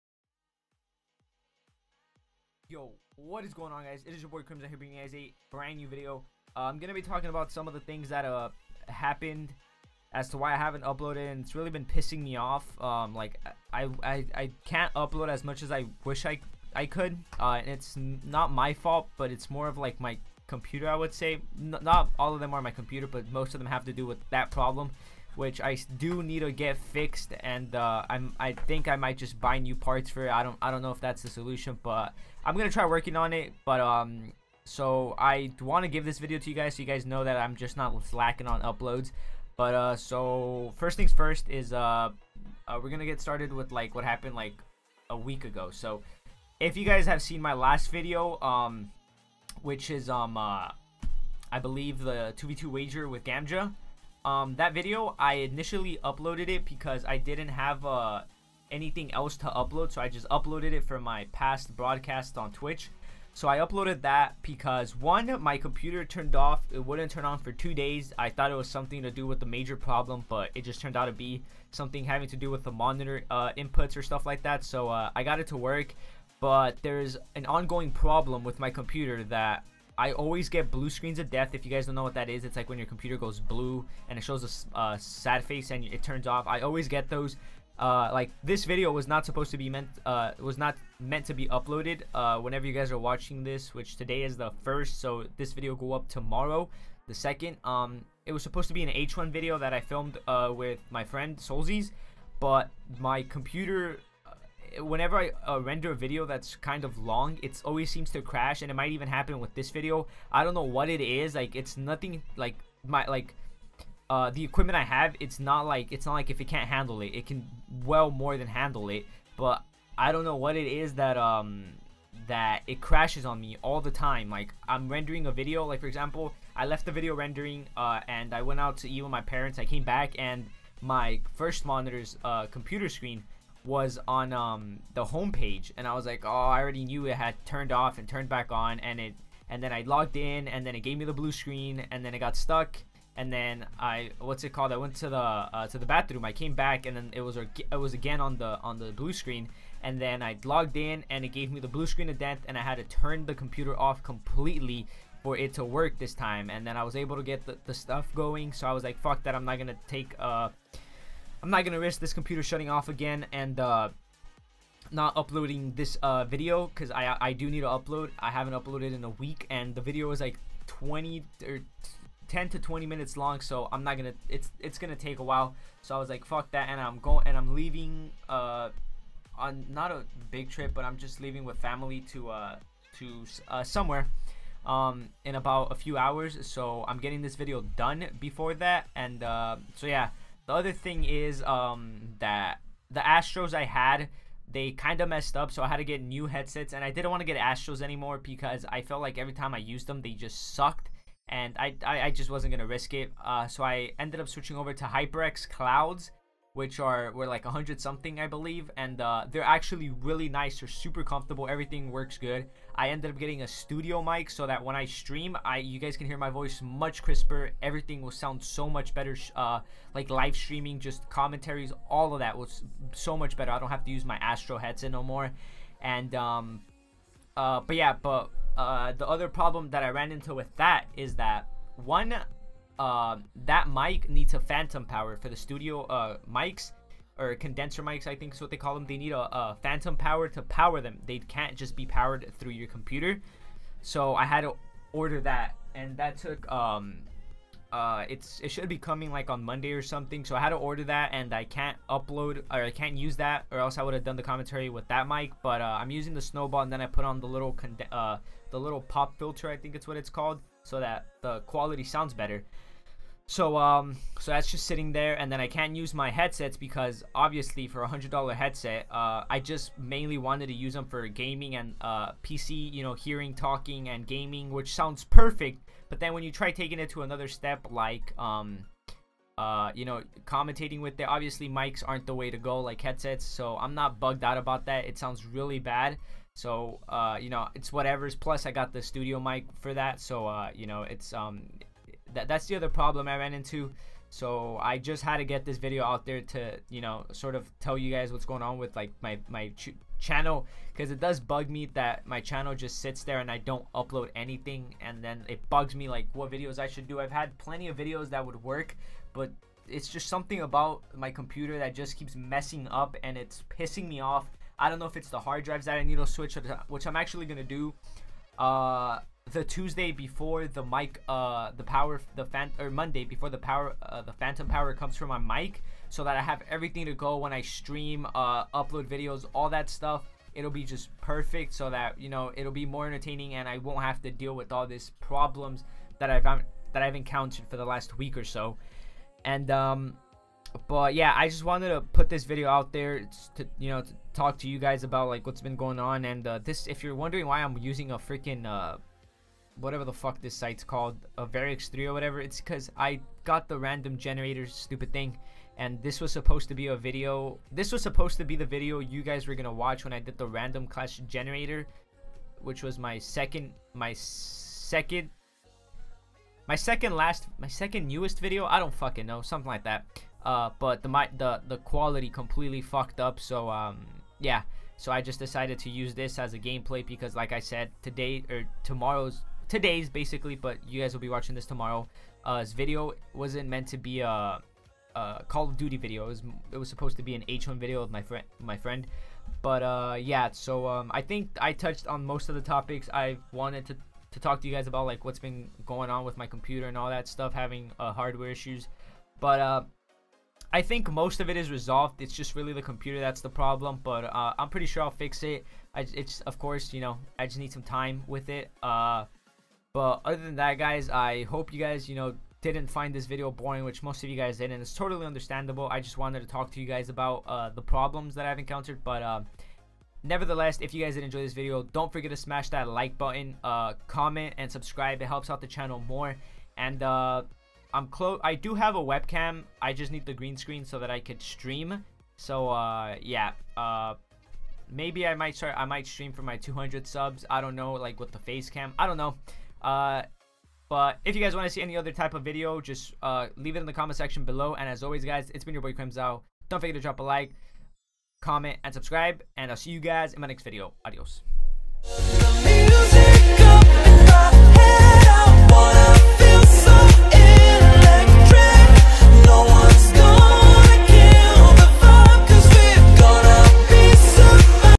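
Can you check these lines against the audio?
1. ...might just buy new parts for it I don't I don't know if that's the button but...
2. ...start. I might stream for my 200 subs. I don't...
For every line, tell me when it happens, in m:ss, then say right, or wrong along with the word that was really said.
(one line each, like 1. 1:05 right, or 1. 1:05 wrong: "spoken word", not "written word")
1. 0:28 wrong: "solution", not "button"
2. 7:15 right.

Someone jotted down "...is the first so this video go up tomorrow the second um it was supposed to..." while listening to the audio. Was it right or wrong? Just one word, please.
right.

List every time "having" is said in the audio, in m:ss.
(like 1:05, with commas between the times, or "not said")
1:12, 6:37.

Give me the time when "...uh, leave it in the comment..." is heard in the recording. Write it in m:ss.
7:23.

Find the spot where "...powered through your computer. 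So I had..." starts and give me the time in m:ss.
4:01.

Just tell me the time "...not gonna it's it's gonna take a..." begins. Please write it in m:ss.
2:53.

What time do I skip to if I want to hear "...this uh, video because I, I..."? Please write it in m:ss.
2:45.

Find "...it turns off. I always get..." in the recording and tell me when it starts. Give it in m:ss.
1:25.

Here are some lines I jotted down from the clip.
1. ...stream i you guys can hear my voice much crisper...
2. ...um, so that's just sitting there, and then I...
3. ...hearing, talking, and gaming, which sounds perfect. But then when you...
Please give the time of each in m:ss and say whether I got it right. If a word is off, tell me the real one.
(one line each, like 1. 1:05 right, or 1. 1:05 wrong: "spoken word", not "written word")
1. 3:34 right
2. 4:23 right
3. 4:32 right.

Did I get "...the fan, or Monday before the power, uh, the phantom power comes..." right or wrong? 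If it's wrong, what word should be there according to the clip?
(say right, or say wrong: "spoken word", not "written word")
right.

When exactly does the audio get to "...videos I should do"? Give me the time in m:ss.
5:06.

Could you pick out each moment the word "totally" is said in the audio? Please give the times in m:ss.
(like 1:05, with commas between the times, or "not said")
6:54.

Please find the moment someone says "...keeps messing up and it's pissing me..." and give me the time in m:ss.
5:11.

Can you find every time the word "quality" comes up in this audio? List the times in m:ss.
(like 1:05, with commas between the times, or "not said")
4:21, 6:11.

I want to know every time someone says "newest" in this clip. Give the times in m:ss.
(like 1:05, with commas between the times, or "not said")
6:07.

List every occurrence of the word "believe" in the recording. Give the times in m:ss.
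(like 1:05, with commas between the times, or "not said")
0:51, 3:28.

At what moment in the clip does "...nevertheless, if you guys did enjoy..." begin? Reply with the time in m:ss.
7:00.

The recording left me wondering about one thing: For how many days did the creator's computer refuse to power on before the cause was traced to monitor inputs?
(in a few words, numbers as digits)
2.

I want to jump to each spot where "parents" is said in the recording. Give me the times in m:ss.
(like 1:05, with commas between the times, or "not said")
2:09.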